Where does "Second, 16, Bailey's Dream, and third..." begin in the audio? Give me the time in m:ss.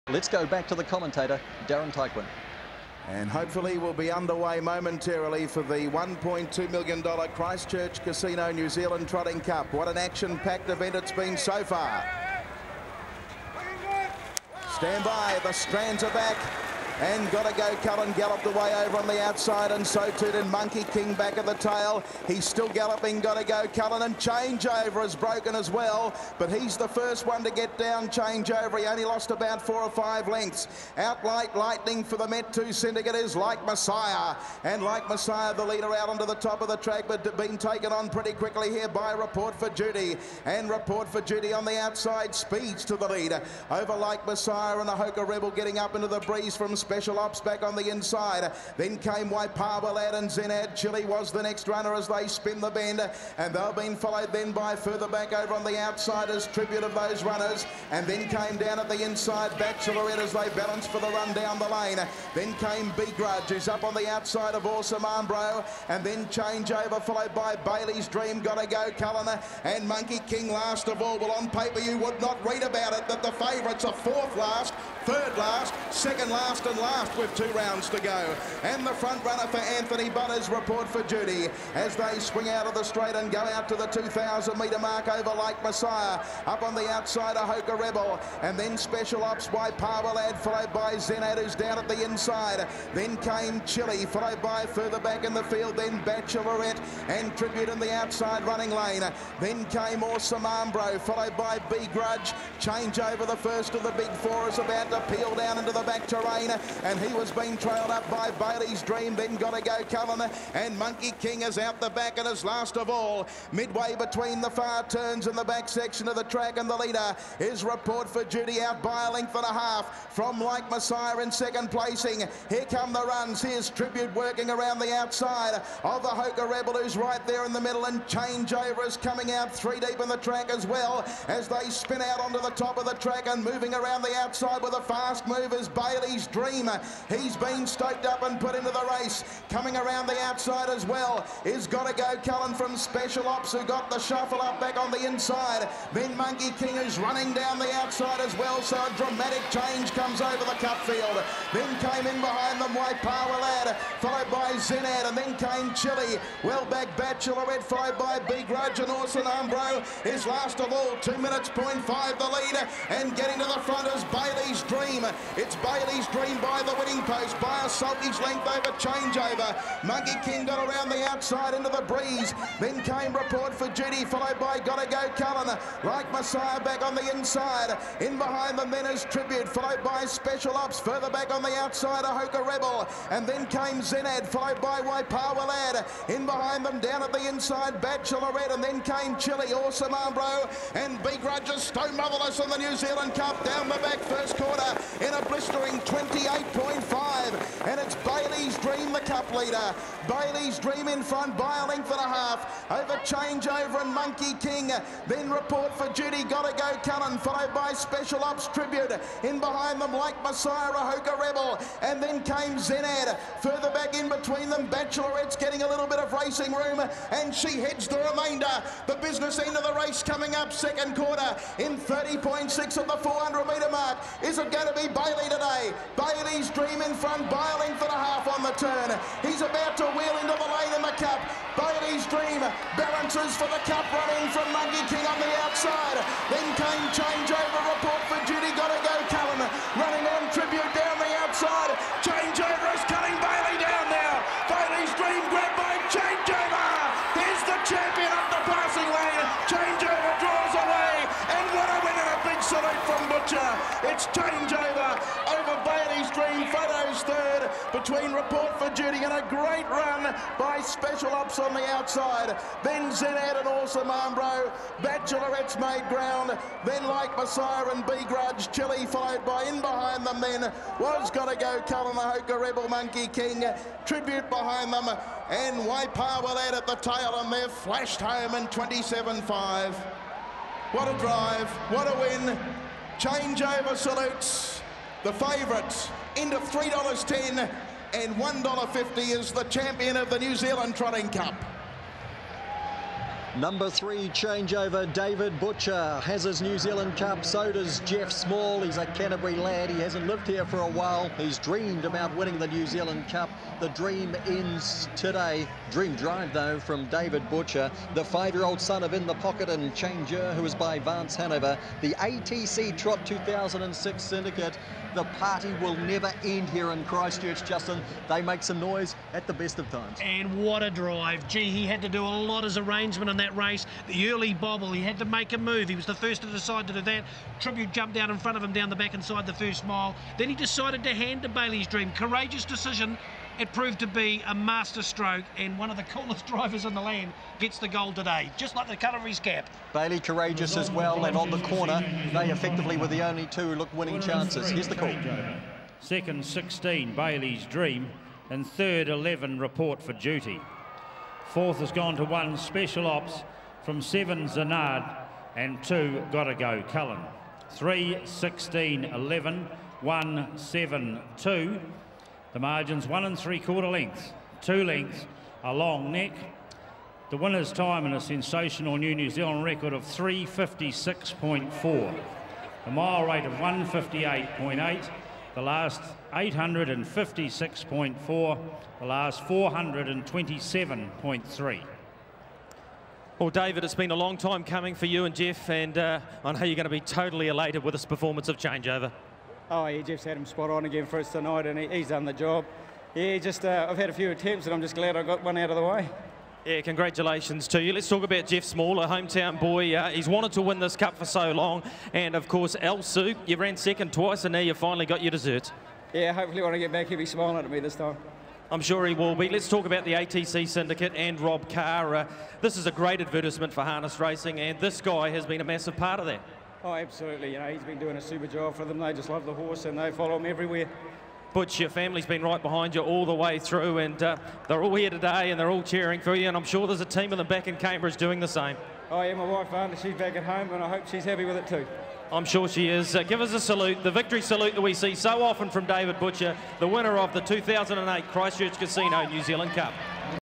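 5:45.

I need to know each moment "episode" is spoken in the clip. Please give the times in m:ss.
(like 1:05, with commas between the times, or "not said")
not said.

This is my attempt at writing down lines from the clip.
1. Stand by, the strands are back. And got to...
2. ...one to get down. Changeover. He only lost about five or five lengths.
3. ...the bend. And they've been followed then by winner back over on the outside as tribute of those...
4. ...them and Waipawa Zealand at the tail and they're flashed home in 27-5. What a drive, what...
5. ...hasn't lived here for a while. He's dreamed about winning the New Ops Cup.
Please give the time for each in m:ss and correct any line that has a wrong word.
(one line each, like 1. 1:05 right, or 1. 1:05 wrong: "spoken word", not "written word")
1. 0:14 right
2. 0:27 wrong: "four", not "five"
3. 0:52 wrong: "further", not "winner"
4. 4:34 wrong: "Lad", not "Zealand"
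5. 4:59 wrong: "Zealand", not "Ops".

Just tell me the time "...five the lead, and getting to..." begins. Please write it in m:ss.
2:41.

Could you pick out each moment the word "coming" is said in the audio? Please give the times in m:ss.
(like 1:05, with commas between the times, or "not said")
2:08, 2:19, 3:40, 6:24.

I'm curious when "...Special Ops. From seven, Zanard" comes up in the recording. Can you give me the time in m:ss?
5:52.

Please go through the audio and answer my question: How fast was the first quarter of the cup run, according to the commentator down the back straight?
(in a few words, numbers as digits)
28.5.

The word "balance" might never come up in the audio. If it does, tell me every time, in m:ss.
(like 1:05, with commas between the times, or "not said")
1:00, 3:52.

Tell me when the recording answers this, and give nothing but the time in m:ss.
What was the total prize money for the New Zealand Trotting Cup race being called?
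0:05.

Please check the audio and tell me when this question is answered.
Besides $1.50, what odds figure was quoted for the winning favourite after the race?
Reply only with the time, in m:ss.
4:46.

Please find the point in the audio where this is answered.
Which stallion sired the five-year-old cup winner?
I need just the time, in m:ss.
5:08.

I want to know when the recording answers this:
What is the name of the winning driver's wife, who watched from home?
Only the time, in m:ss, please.
7:09.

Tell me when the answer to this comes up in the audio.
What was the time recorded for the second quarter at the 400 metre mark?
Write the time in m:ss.
3:41.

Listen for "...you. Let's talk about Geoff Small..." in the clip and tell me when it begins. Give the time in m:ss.
6:37.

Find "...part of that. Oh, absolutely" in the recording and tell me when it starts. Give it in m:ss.
6:55.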